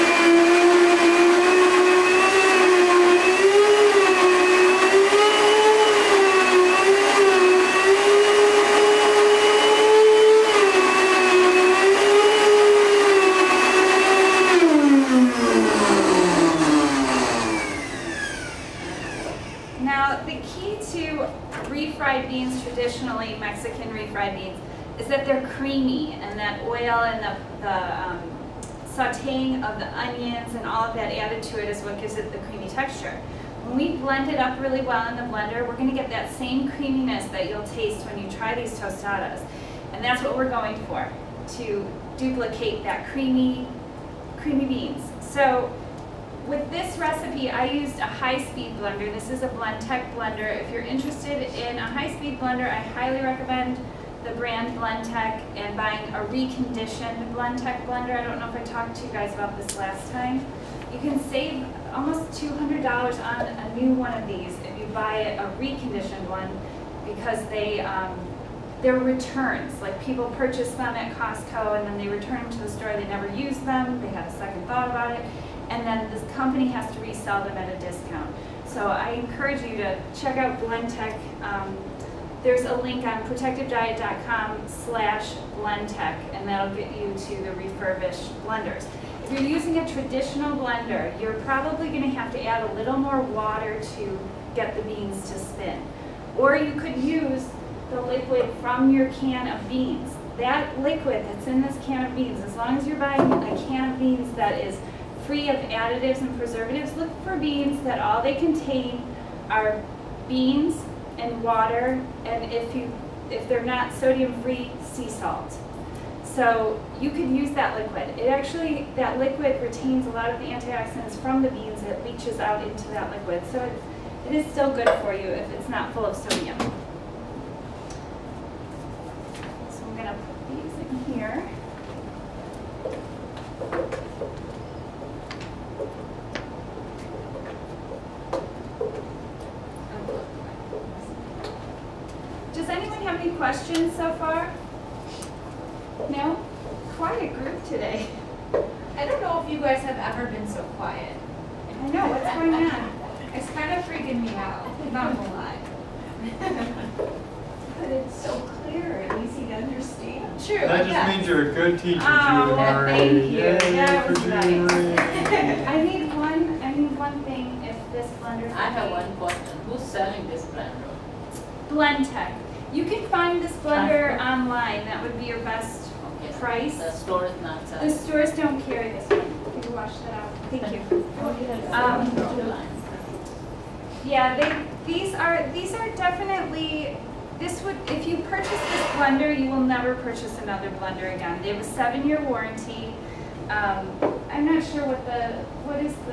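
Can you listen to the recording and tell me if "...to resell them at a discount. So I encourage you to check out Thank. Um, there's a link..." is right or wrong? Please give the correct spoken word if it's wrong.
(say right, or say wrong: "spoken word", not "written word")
wrong: "Blendtec", not "Thank".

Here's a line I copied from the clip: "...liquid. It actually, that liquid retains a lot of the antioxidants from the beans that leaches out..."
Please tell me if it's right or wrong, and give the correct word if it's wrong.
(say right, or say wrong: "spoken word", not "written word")
right.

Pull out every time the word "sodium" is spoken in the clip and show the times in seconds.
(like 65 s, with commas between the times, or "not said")
113 s, 126 s.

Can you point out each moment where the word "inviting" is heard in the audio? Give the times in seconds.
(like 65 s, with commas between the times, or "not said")
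not said.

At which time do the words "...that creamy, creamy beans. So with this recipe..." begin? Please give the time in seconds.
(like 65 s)
42 s.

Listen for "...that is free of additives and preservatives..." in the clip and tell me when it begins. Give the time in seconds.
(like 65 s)
104 s.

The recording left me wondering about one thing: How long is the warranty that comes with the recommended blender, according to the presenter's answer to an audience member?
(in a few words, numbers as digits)
7 years.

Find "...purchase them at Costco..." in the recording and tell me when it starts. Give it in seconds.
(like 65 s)
70 s.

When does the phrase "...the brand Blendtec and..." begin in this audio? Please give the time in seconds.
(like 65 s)
54 s.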